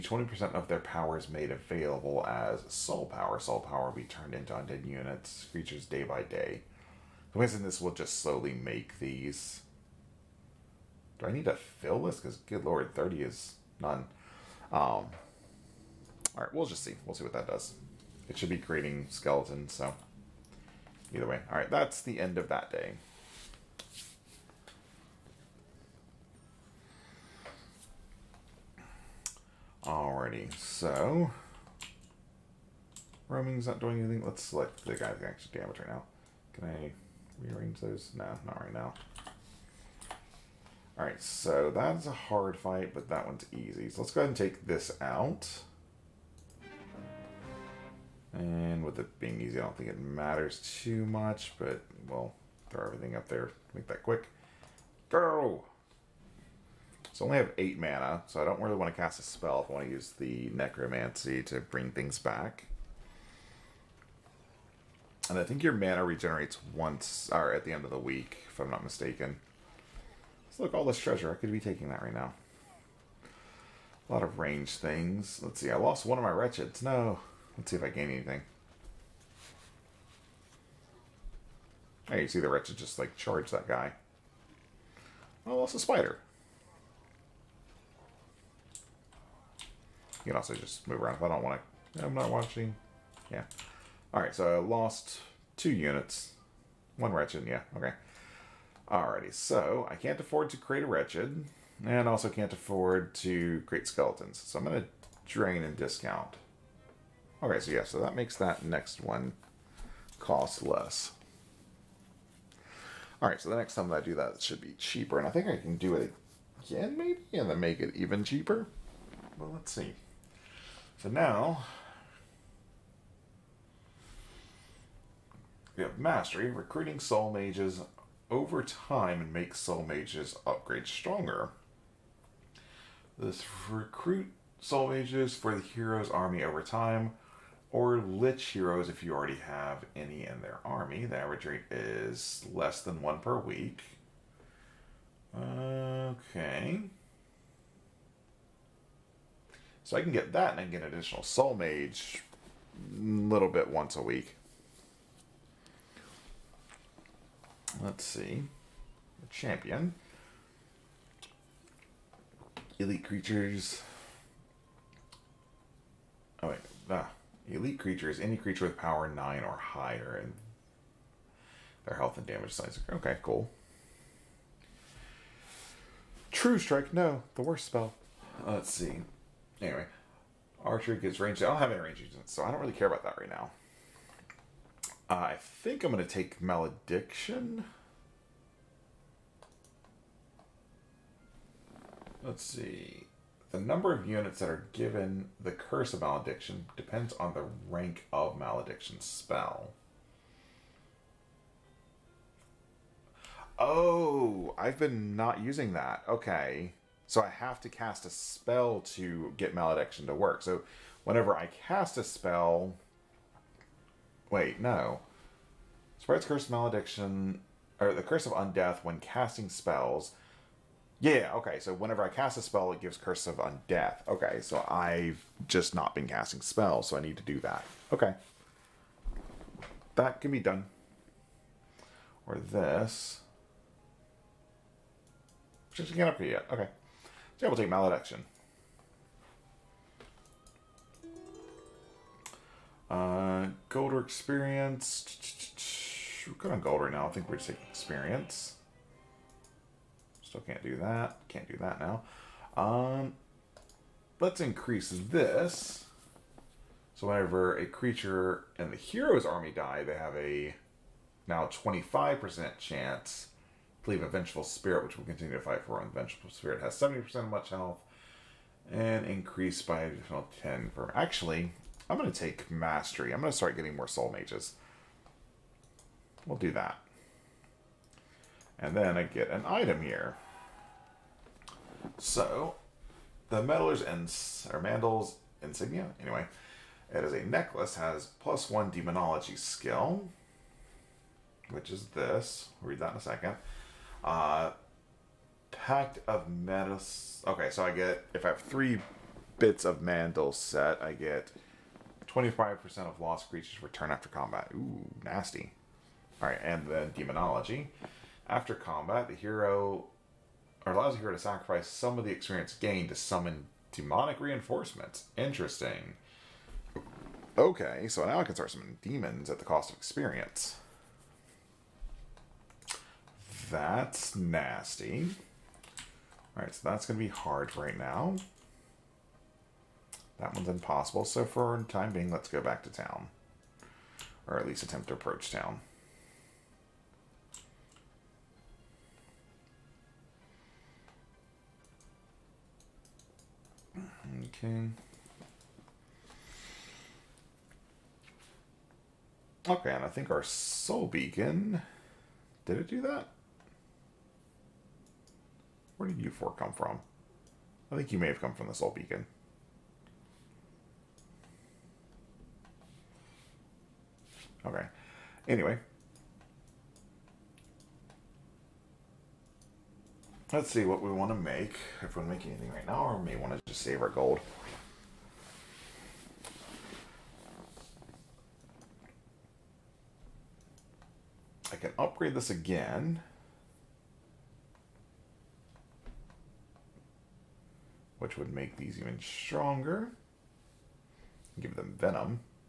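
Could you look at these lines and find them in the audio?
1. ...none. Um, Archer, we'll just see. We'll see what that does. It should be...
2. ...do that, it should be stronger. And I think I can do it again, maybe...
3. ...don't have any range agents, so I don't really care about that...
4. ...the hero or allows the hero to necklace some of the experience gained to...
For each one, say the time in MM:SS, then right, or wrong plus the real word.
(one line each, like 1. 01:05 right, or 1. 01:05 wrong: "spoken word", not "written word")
1. 00:13 wrong: "Alright", not "Archer"
2. 01:54 wrong: "cheaper", not "stronger"
3. 03:01 right
4. 05:09 wrong: "sacrifice", not "necklace".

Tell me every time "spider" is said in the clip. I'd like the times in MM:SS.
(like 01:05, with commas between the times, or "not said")
01:25.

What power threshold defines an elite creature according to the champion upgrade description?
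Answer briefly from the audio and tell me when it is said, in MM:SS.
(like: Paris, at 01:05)
9 or higher, at 02:48.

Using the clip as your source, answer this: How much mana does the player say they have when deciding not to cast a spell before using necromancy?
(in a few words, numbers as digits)
8.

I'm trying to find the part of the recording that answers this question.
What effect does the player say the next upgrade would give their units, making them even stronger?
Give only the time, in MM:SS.
06:31.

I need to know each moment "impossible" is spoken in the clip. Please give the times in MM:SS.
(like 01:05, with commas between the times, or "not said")
05:30.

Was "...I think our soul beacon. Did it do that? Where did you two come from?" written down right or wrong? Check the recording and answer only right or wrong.
wrong.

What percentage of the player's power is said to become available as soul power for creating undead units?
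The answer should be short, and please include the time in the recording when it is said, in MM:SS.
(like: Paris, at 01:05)
20%, at 00:00.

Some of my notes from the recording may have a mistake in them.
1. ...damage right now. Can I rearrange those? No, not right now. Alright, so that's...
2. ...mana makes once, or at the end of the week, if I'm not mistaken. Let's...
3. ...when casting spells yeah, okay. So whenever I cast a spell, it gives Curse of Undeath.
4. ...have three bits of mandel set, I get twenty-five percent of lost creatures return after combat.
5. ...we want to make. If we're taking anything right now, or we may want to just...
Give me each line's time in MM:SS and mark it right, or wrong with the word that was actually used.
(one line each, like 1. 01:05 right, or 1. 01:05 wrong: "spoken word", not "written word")
1. 00:35 right
2. 01:05 wrong: "regenerates", not "makes"
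3. 03:38 right
4. 04:58 right
5. 06:10 wrong: "making", not "taking".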